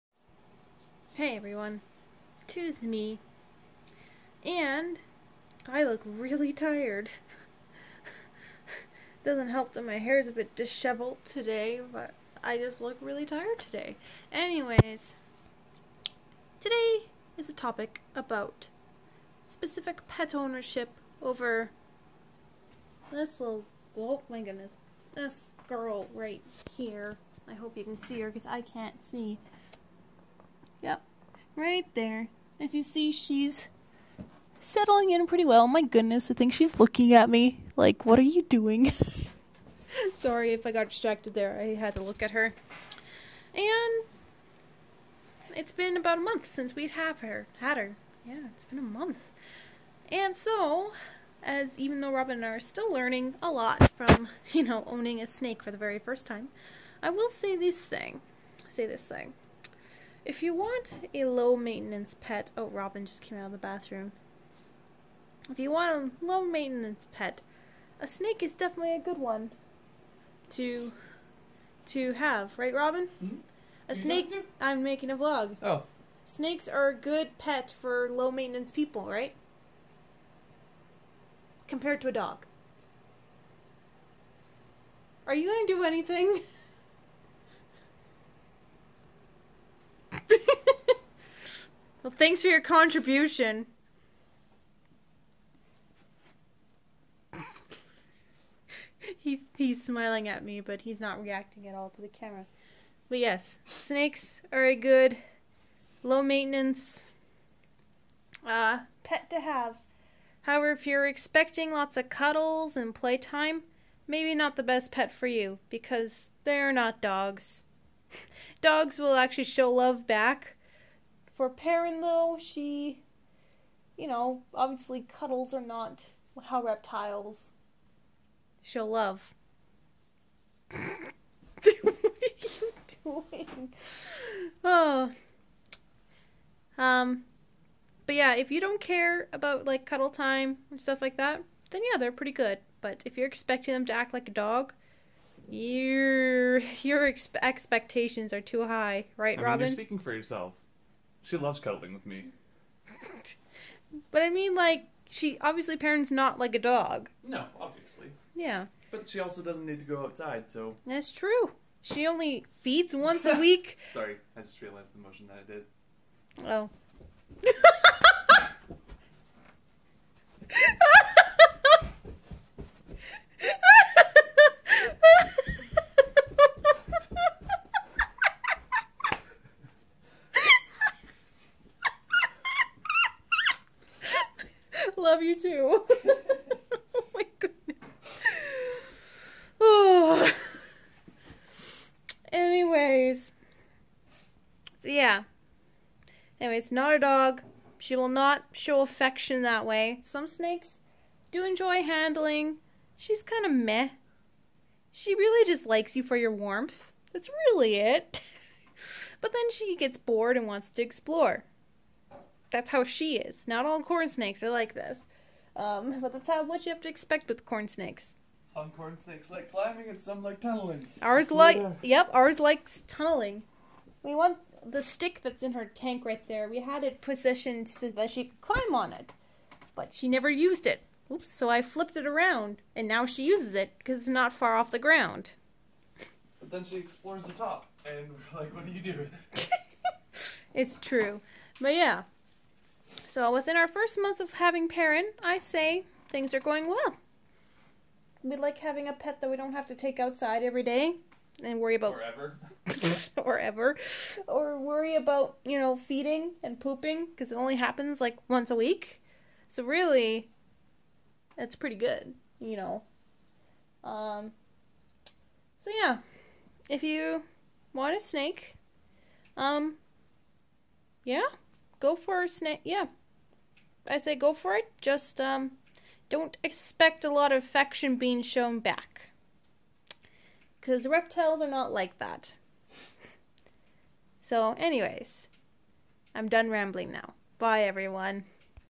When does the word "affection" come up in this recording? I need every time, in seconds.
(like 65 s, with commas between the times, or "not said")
198 s, 277 s.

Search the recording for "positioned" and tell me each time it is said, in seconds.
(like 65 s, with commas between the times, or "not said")
227 s.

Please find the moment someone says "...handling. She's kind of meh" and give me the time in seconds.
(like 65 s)
201 s.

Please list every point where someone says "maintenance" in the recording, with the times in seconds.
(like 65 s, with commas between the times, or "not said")
61 s, 66 s, 78 s, 106 s.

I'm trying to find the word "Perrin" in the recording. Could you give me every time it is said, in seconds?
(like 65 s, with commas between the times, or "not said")
121 s, 155 s, 244 s.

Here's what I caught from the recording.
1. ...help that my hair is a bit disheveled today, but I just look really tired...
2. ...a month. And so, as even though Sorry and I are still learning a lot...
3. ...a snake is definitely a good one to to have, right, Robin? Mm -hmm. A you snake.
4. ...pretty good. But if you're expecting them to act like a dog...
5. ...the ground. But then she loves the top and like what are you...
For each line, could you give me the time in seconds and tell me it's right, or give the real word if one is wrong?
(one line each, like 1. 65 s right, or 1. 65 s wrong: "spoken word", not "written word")
1. 9 s right
2. 48 s wrong: "Robin", not "Sorry"
3. 67 s right
4. 142 s right
5. 234 s wrong: "explores", not "loves".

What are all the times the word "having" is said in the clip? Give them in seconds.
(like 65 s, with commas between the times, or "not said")
244 s, 248 s.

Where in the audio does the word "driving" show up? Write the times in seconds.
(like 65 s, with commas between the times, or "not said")
not said.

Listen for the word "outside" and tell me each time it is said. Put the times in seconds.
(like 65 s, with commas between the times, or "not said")
160 s, 249 s.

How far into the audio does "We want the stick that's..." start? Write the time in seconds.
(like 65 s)
224 s.